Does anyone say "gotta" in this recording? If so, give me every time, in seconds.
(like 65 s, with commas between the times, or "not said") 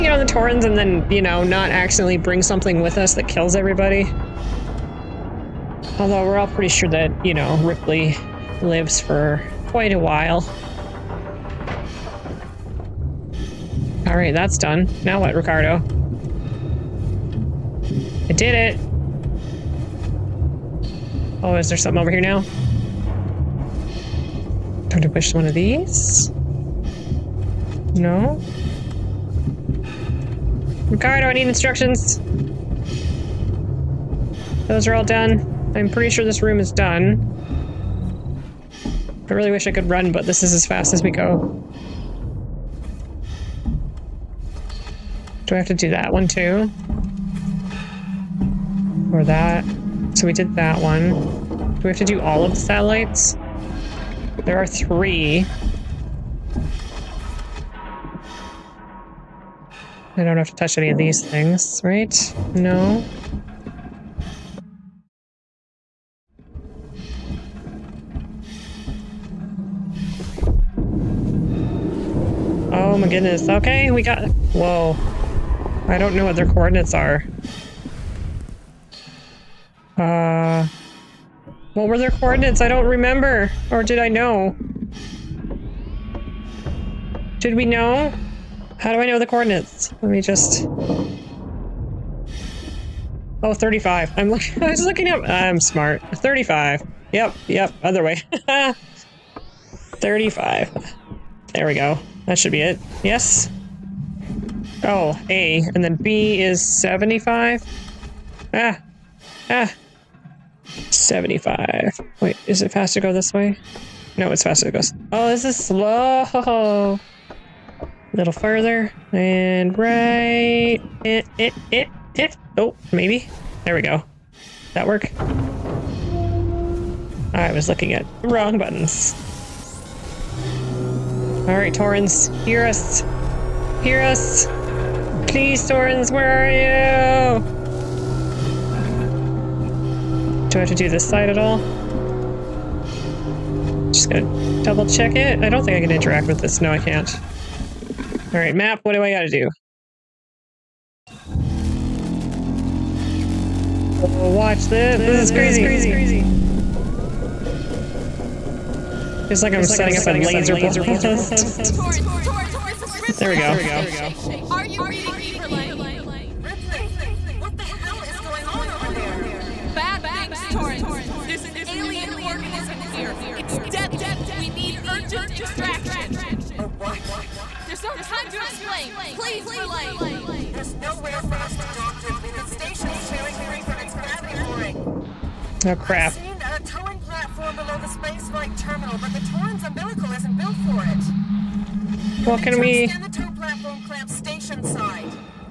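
149 s.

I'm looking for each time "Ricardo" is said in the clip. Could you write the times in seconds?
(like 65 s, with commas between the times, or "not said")
15 s, 30 s.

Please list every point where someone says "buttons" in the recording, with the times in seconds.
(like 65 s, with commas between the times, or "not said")
128 s.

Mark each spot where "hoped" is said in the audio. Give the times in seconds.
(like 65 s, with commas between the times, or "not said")
not said.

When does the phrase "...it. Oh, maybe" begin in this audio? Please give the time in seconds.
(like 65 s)
122 s.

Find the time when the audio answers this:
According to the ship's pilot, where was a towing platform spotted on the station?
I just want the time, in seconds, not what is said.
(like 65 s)
187 s.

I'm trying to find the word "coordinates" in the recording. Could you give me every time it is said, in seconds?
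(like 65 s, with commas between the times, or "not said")
76 s, 82 s, 89 s.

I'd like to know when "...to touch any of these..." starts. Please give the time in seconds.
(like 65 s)
60 s.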